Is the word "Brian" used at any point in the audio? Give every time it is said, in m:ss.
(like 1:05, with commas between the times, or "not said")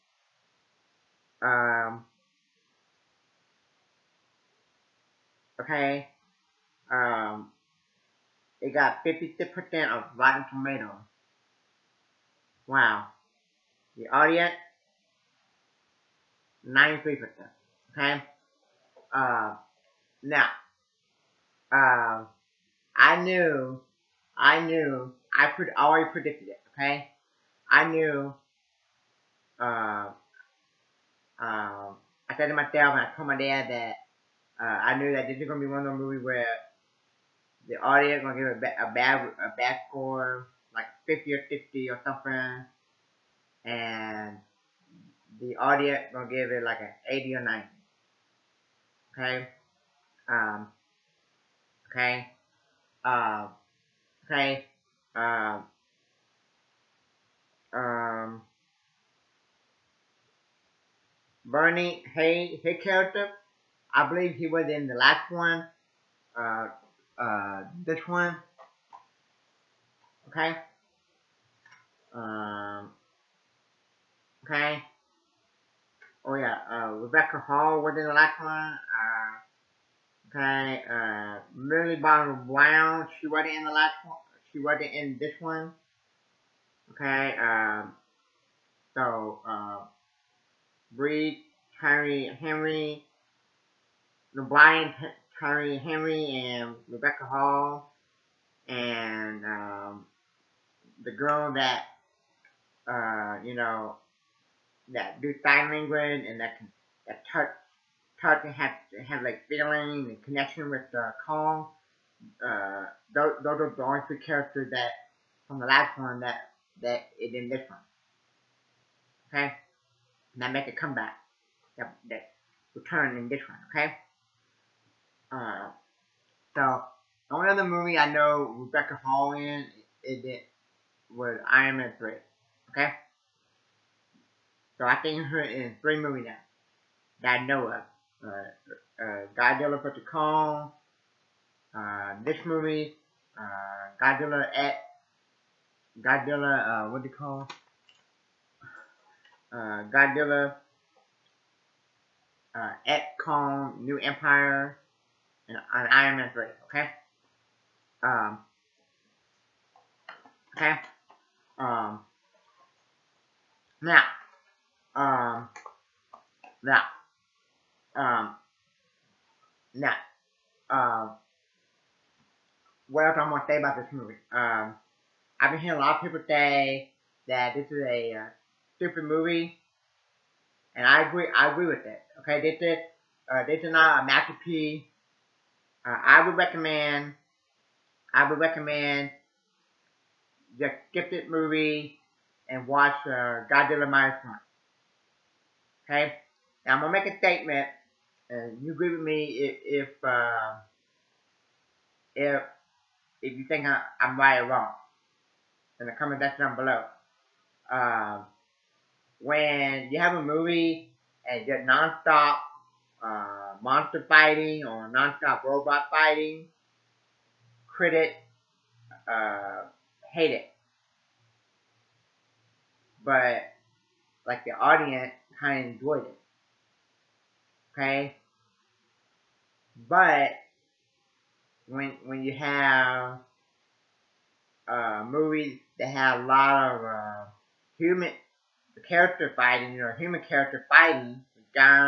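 1:34.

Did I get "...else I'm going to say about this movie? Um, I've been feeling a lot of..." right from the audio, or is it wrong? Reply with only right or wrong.
wrong.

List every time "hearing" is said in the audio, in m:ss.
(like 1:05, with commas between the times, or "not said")
2:55.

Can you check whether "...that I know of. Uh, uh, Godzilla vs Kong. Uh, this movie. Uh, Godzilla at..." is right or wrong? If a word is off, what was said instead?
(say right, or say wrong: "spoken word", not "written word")
right.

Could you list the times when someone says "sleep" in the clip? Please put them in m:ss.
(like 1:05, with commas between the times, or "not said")
not said.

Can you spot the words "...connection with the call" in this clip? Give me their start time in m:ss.
1:50.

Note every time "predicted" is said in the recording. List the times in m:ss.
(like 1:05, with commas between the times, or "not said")
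0:26.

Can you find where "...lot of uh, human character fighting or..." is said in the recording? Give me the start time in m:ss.
3:56.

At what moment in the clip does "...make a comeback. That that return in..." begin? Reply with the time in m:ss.
2:00.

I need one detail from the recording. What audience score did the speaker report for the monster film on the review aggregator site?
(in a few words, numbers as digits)
93%.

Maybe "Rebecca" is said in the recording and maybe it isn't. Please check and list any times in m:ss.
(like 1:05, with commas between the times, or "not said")
1:16, 1:36, 2:08.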